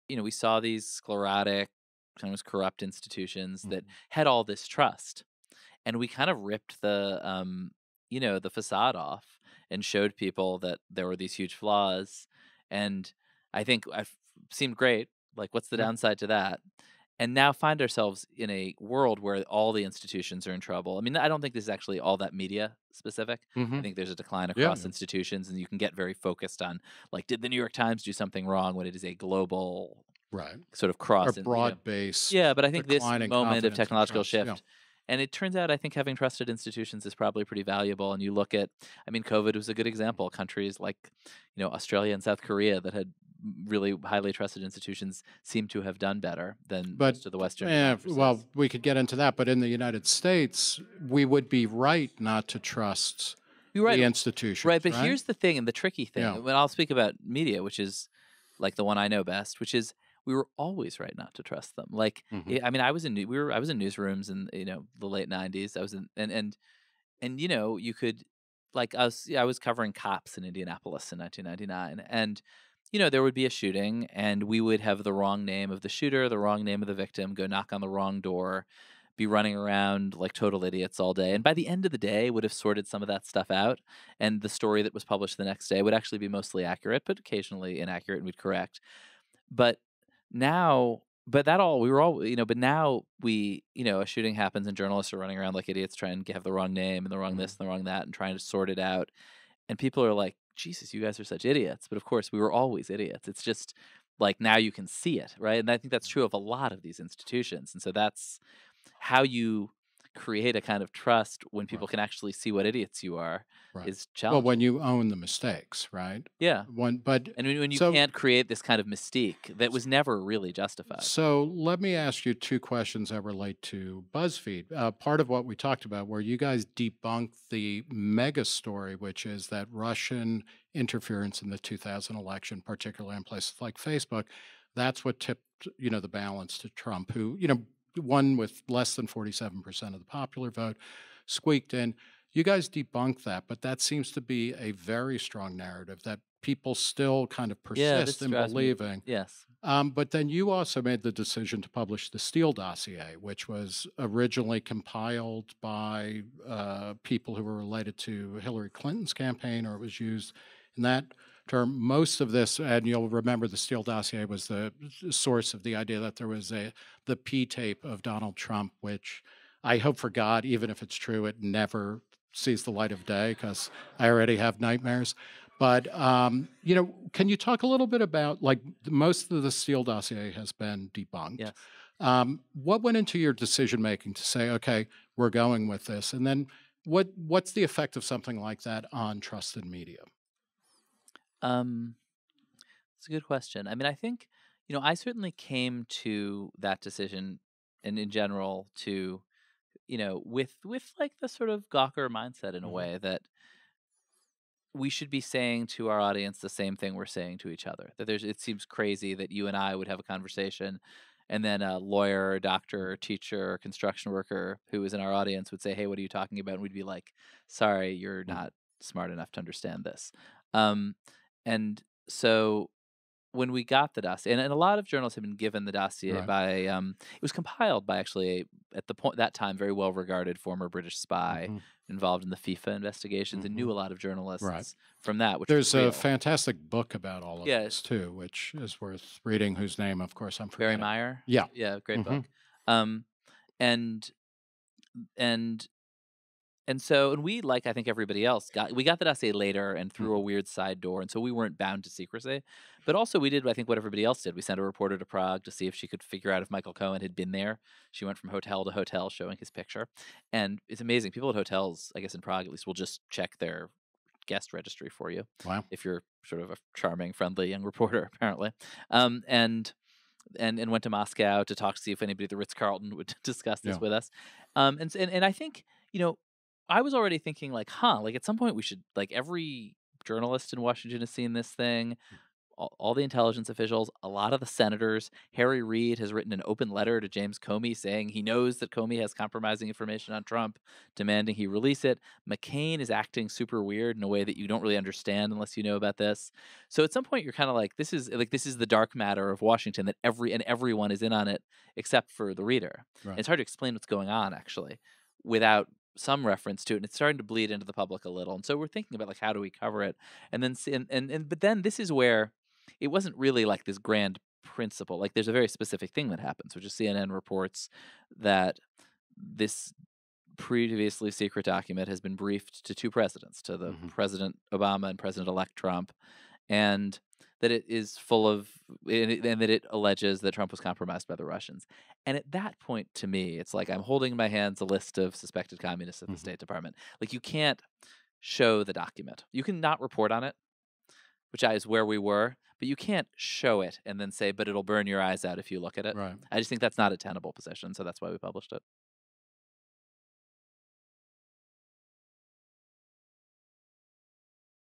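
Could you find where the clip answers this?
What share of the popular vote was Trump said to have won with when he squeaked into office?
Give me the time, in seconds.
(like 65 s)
138 s.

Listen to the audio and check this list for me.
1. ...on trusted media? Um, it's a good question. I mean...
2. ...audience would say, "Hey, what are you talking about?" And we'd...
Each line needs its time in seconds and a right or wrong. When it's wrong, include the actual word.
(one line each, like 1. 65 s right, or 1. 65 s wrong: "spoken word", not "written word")
1. 188 s right
2. 215 s right.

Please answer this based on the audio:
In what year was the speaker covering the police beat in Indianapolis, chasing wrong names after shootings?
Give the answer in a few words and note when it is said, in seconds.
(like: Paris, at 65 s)
1999, at 71 s.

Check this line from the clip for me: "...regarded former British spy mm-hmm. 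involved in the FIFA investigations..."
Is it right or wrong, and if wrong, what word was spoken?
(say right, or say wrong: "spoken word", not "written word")
right.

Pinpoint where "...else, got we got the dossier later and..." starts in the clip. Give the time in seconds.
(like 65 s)
248 s.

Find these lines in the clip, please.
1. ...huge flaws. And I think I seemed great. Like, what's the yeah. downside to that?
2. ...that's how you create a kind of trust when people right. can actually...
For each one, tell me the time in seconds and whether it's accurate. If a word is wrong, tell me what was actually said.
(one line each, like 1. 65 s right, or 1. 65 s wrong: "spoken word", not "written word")
1. 11 s right
2. 107 s right.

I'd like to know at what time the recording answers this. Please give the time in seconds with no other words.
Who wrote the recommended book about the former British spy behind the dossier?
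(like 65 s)
240 s.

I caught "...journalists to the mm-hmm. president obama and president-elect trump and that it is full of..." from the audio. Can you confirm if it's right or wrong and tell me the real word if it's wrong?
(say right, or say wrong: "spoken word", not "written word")
wrong: "presidents", not "journalists".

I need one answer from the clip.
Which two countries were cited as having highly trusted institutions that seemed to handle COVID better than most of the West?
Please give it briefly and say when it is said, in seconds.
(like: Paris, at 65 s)
Australia and South Korea, at 41 s.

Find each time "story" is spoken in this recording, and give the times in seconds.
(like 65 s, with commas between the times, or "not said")
84 s, 128 s.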